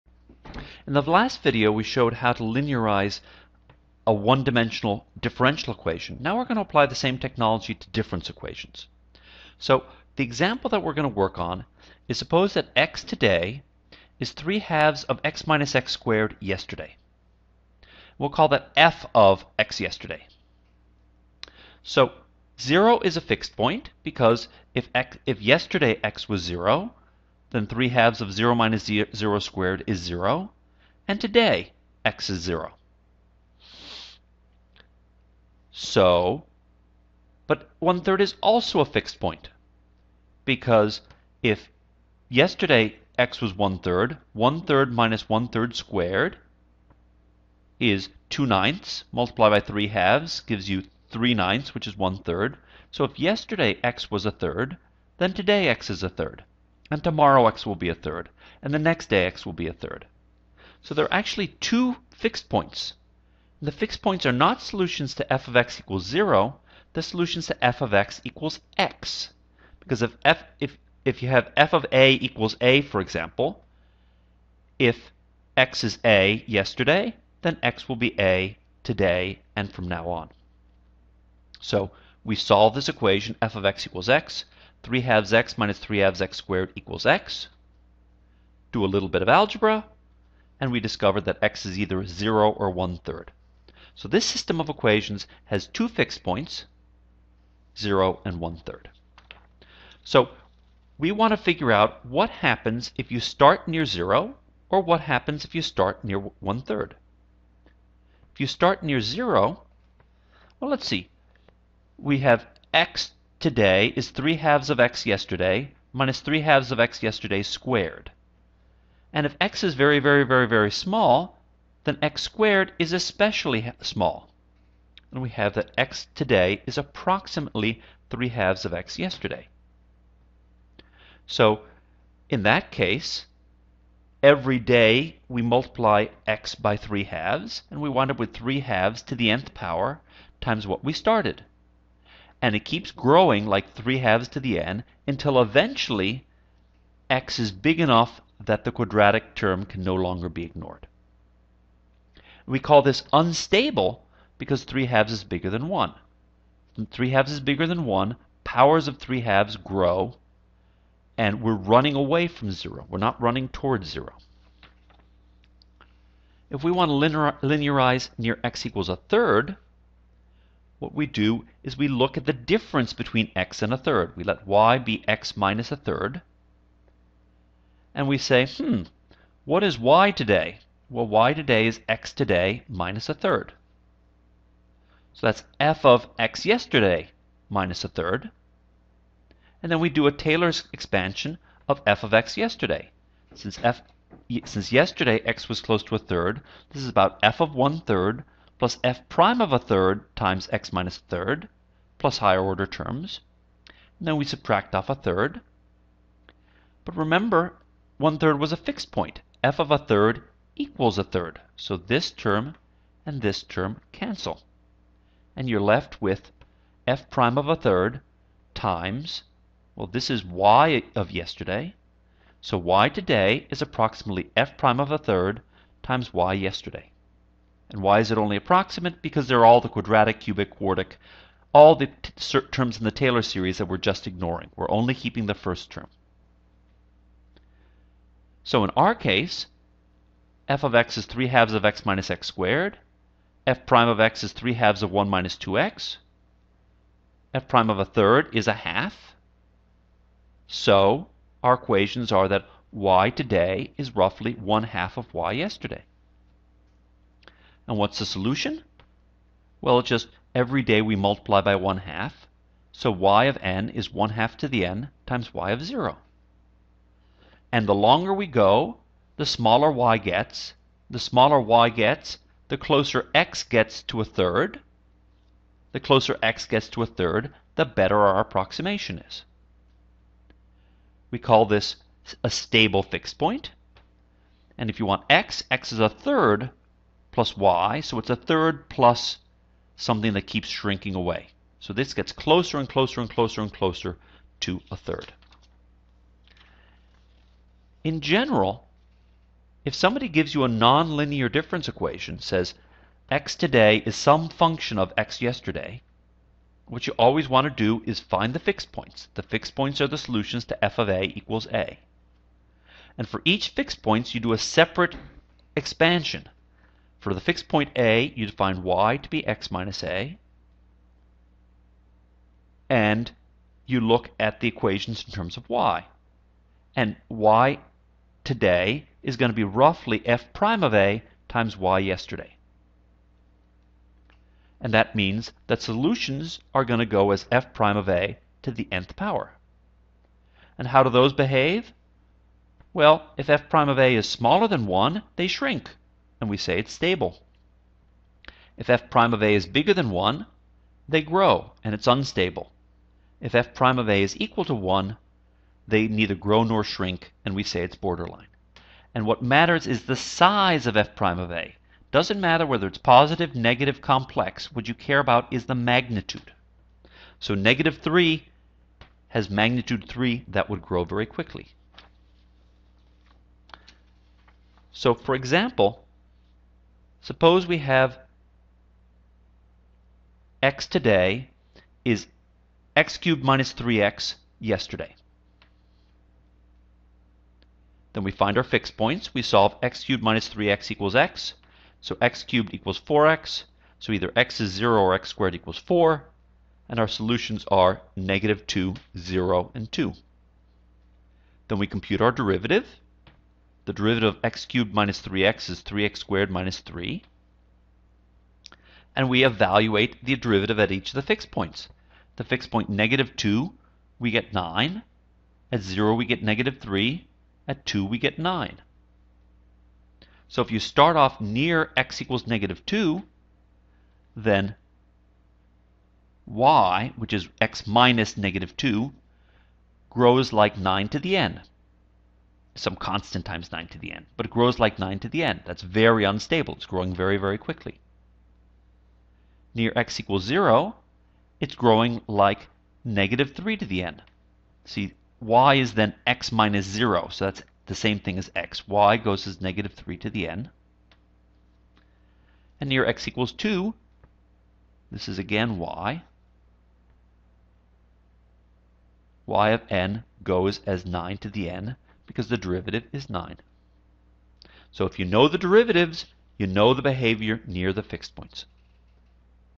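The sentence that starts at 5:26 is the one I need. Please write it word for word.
And y today is going to be roughly f prime of a times y yesterday.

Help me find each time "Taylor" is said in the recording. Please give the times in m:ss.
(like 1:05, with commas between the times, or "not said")
3:10, 3:52.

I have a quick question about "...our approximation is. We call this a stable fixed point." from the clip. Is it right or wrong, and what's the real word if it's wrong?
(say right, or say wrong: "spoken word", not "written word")
right.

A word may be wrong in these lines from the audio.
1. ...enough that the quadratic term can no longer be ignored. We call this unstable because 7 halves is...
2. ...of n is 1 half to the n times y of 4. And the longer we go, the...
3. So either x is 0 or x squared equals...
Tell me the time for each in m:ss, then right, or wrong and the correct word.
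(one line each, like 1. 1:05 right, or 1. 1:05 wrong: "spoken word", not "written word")
1. 2:27 wrong: "3", not "7"
2. 4:23 wrong: "0", not "4"
3. 6:33 right.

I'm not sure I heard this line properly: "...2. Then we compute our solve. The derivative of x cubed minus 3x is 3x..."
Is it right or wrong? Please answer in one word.
wrong.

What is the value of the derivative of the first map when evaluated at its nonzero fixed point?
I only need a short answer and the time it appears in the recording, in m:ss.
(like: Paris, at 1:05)
1/2, at 4:07.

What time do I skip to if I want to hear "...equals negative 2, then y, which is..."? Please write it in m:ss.
7:02.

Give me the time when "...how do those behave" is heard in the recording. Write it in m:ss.
5:40.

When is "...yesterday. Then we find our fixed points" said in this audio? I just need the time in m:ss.
6:24.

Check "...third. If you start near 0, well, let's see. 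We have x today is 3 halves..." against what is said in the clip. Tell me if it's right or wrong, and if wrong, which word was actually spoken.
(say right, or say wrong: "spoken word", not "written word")
right.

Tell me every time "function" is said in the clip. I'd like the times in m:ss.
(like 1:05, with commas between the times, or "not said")
5:04.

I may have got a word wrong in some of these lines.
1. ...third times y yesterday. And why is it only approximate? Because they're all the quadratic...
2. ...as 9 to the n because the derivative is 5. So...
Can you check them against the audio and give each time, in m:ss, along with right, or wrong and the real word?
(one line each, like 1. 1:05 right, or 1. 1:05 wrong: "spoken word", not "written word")
1. 3:44 right
2. 7:40 wrong: "9", not "5".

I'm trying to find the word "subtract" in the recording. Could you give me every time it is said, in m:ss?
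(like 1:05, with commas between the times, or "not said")
3:24.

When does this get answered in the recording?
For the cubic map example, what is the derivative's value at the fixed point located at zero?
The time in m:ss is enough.
6:55.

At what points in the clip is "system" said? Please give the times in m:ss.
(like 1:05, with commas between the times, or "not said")
1:34.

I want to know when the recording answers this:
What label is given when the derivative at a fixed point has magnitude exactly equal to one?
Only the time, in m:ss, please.
5:57.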